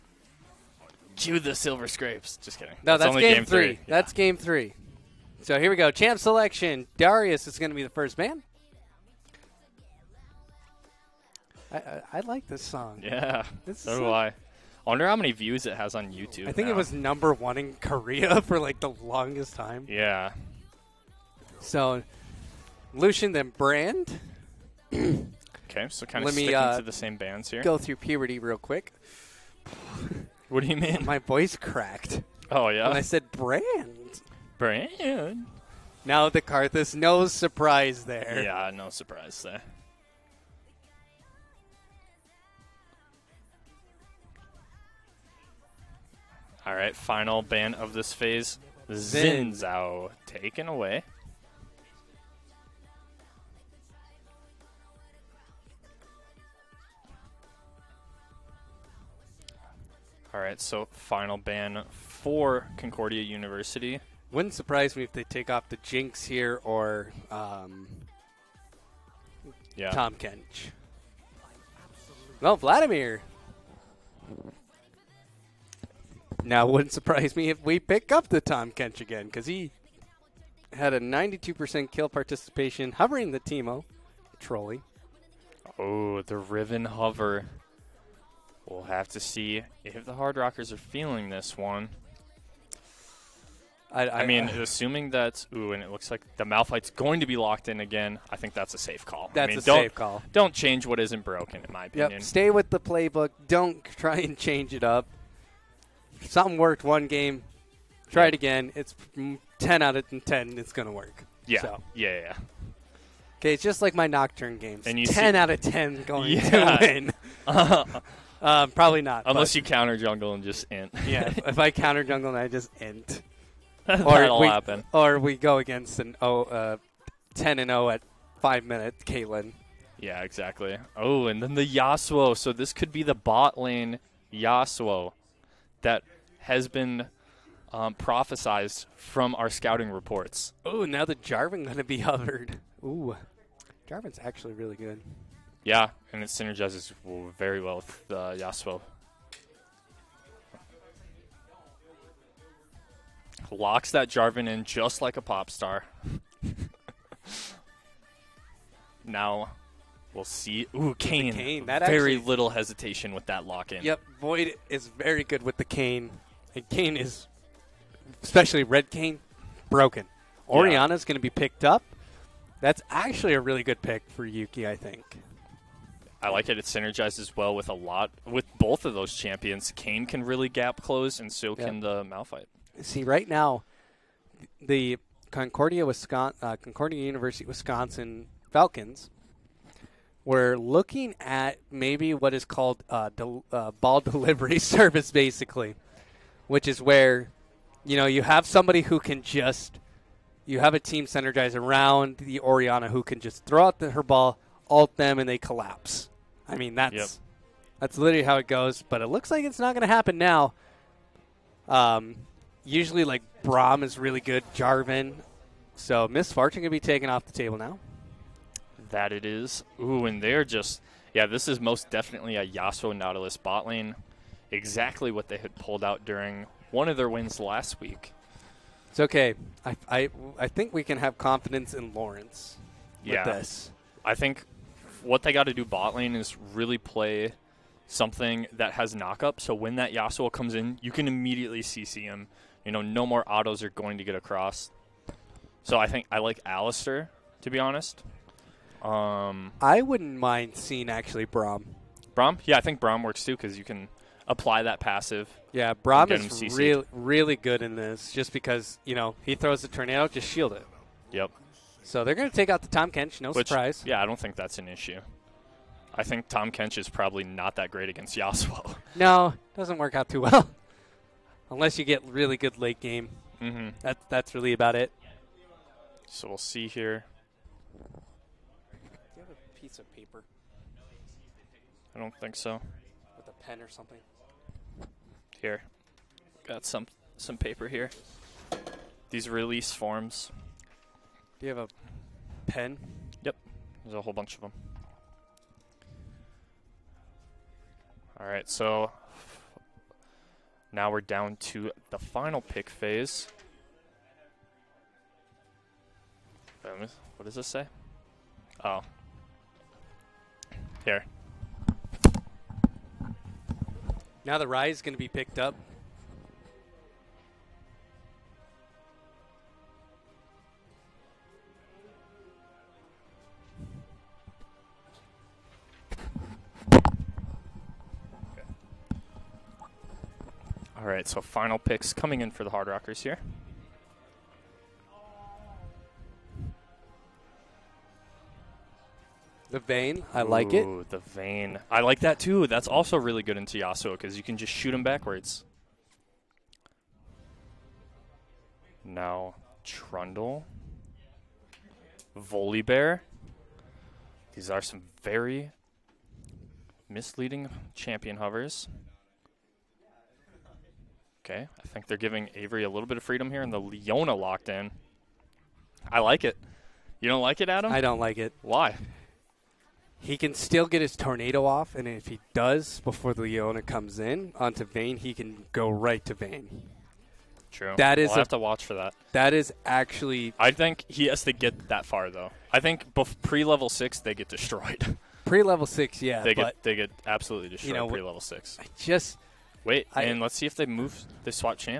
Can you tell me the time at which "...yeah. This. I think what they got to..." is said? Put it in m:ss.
3:53.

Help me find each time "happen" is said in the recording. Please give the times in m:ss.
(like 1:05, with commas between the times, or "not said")
2:04, 3:29.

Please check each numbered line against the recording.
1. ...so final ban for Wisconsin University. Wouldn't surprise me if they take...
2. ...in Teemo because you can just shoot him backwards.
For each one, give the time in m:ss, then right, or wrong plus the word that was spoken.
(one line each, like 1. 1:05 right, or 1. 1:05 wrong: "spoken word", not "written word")
1. 1:00 wrong: "Concordia", not "Wisconsin"
2. 5:43 wrong: "Tiasso", not "Teemo".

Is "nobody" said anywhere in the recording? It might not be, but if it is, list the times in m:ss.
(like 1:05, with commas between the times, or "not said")
not said.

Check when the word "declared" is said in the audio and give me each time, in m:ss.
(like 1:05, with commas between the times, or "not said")
not said.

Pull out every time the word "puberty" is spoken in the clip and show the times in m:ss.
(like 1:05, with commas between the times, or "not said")
0:27.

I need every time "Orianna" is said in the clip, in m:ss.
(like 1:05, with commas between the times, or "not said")
2:50, 3:22.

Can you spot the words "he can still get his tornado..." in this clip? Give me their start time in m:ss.
6:09.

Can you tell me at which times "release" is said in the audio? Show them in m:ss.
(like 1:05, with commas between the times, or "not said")
4:49.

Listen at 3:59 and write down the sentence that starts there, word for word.
So when that Yasuo comes in, you can immediately CC him.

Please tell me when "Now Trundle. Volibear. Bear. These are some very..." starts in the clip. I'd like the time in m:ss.
5:48.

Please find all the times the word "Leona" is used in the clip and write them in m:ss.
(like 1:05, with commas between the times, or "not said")
6:03, 6:13.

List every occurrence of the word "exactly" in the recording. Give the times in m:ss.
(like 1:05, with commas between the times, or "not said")
2:10, 3:44.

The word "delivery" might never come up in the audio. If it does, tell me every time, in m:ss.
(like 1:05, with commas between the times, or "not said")
3:14.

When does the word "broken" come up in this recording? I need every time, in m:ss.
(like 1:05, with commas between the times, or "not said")
1:41, 2:49.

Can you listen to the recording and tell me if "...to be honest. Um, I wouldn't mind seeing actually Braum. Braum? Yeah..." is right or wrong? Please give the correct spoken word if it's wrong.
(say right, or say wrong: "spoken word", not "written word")
right.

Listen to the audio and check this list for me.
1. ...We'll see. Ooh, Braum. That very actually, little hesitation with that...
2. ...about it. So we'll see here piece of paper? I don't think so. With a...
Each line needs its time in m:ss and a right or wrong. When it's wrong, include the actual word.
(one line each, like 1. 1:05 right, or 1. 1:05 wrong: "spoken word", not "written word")
1. 2:40 wrong: "Kayn", not "Braum"
2. 4:34 right.